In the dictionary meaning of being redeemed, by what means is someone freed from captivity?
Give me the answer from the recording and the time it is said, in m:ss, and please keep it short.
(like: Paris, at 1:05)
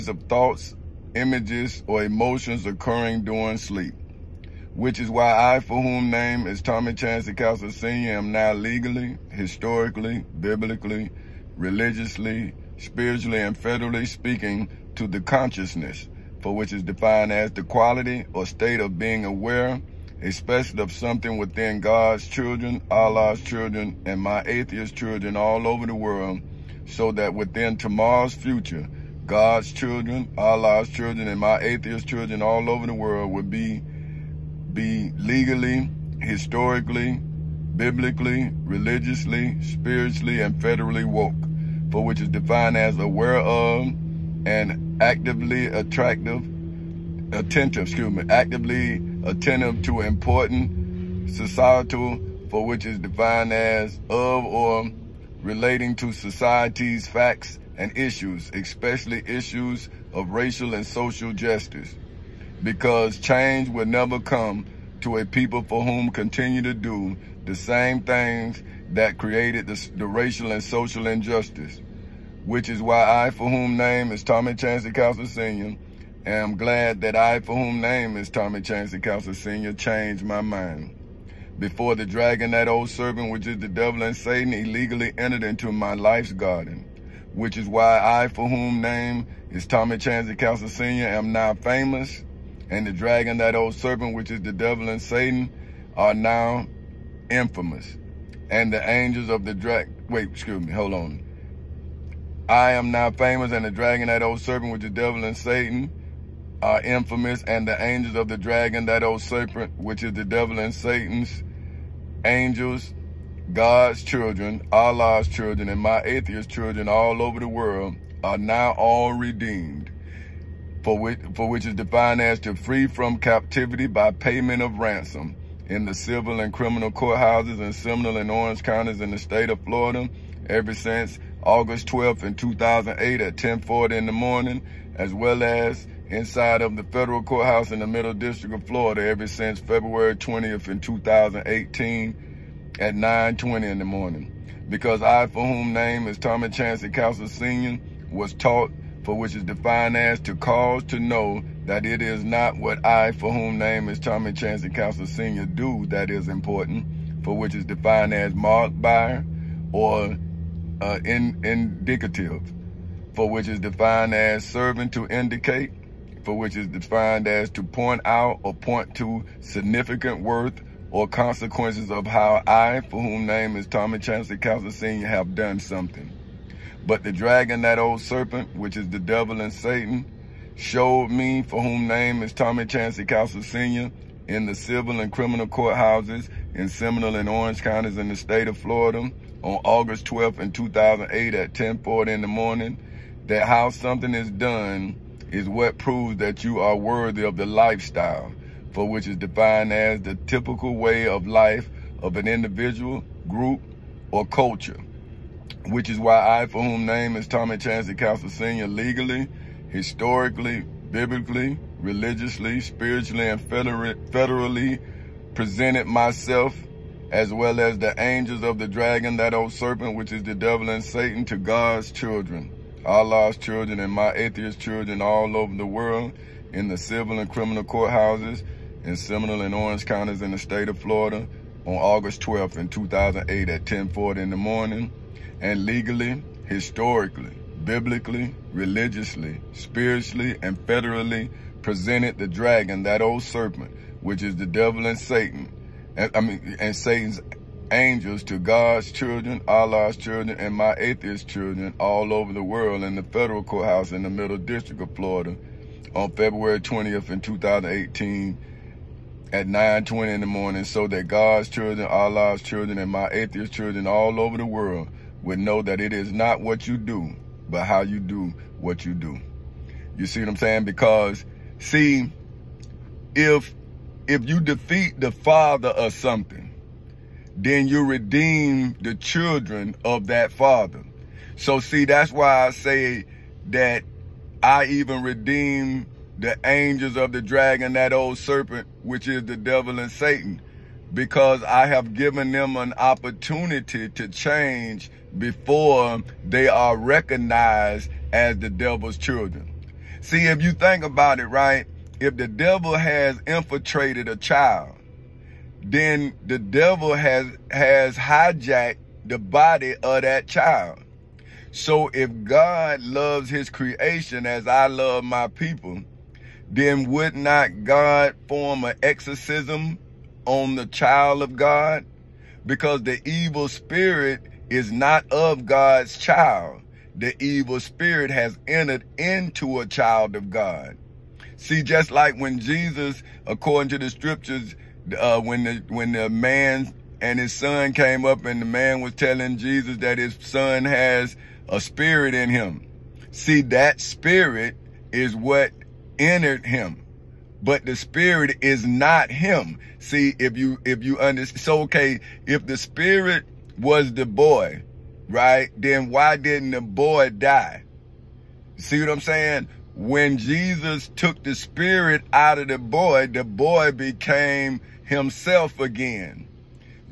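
payment of ransom, at 2:04.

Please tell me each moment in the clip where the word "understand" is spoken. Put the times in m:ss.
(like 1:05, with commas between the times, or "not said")
5:51.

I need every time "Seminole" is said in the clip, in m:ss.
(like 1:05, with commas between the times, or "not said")
2:07, 3:06, 3:48.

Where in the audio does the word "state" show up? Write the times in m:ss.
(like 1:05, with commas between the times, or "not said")
0:18, 2:09, 3:08, 3:50.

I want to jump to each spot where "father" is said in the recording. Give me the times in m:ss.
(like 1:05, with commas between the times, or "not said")
4:35, 4:40.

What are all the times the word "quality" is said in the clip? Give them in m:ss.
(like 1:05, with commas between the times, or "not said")
0:17.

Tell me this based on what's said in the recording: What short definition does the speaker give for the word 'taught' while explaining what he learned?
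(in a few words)
to cause to know.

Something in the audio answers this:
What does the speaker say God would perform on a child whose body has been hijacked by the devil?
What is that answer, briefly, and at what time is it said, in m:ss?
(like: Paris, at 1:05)
an exorcism, at 5:18.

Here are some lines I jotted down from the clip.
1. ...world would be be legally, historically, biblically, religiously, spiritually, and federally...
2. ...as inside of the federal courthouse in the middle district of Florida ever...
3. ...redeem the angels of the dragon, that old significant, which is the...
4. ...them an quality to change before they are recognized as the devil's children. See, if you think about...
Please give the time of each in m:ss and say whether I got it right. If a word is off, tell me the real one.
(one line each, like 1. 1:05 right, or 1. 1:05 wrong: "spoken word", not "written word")
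1. 0:32 right
2. 2:15 right
3. 4:45 wrong: "serpent", not "significant"
4. 4:52 wrong: "opportunity", not "quality".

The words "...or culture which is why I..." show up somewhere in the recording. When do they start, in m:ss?
3:24.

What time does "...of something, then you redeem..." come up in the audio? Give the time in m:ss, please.
4:35.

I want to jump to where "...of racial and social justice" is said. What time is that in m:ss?
1:00.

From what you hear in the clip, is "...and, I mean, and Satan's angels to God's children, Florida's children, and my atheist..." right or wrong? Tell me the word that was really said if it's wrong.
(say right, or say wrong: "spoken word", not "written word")
wrong: "Allah", not "Florida".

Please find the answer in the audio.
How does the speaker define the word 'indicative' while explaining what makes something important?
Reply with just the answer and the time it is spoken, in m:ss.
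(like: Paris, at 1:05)
serving to indicate, at 2:44.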